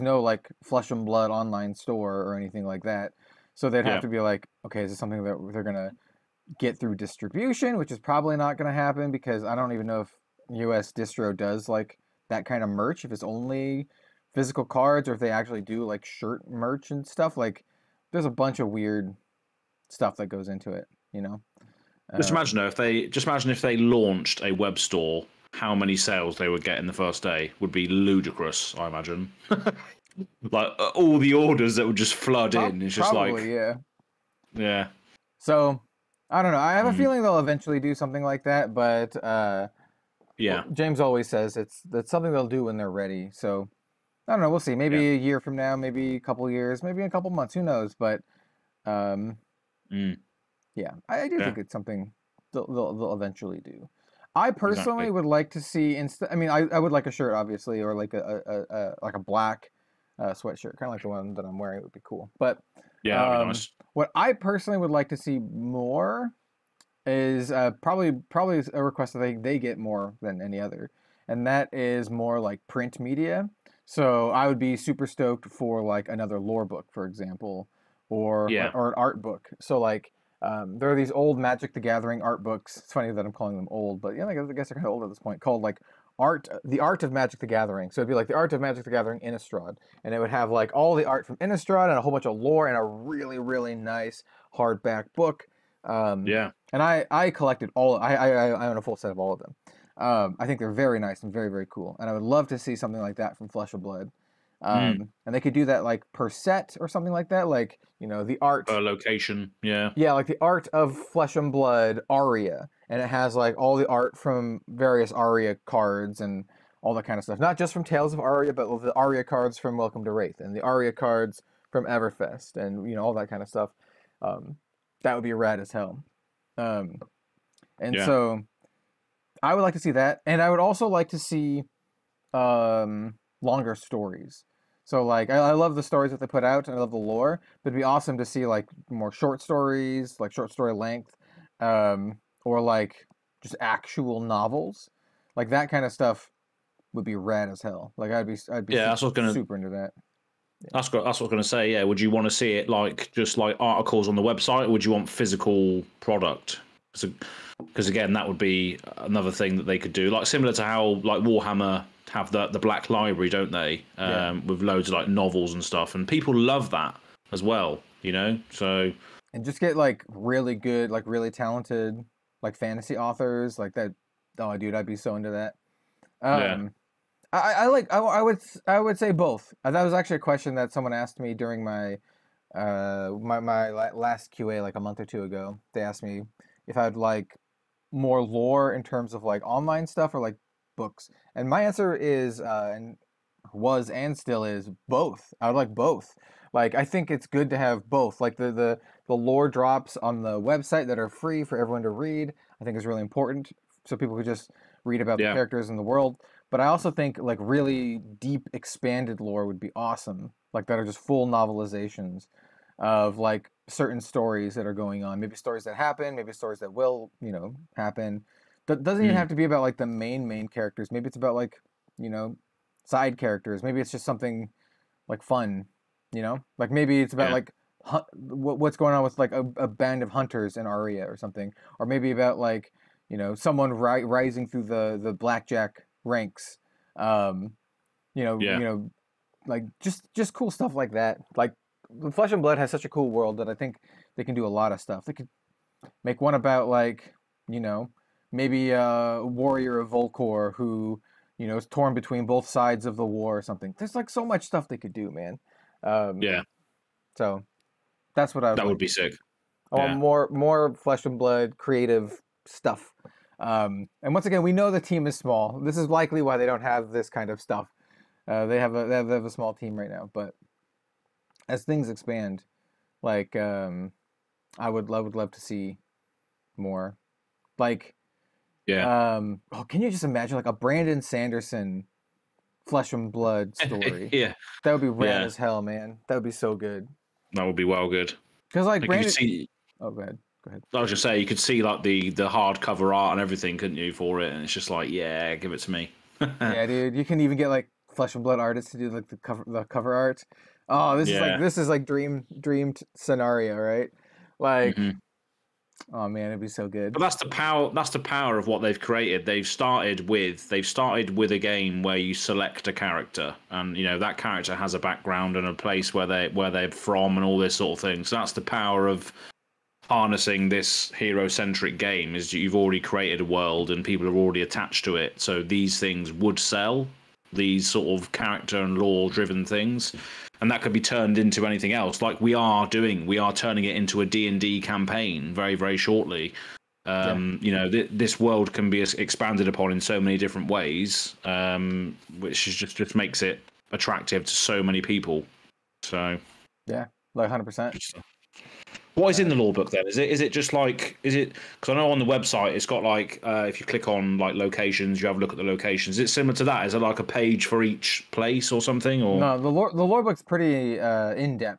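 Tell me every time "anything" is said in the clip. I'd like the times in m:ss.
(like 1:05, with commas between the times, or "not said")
0:02, 5:31.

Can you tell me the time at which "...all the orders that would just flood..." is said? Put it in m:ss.
0:30.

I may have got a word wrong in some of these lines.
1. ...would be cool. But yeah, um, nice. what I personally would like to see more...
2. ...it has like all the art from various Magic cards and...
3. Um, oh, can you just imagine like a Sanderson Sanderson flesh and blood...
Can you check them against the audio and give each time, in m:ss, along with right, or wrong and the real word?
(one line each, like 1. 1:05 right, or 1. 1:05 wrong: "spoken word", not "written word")
1. 1:01 right
2. 1:53 wrong: "Aria", not "Magic"
3. 4:39 wrong: "Brandon", not "Sanderson".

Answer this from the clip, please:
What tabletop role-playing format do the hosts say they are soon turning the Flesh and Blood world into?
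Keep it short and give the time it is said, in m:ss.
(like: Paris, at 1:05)
D&D campaign, at 5:34.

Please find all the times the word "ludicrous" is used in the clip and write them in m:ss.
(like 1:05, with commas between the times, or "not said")
0:27.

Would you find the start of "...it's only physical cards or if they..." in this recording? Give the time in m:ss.
0:13.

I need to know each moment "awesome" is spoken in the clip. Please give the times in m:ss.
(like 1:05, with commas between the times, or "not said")
2:17, 3:29.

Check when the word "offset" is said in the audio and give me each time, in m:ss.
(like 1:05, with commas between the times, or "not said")
not said.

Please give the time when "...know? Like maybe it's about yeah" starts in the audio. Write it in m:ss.
3:46.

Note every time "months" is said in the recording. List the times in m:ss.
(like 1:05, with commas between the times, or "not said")
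0:47, 3:04.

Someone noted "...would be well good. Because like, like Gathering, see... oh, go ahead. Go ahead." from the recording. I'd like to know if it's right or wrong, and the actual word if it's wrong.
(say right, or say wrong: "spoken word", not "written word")
wrong: "Brandon", not "Gathering".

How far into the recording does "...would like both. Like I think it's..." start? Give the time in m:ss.
3:15.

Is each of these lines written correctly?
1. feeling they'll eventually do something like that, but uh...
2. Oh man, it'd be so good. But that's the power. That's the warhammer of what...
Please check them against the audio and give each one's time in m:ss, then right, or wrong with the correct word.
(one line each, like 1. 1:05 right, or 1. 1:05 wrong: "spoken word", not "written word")
1. 0:36 right
2. 5:05 wrong: "power", not "warhammer".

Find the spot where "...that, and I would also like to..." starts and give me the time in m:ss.
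2:09.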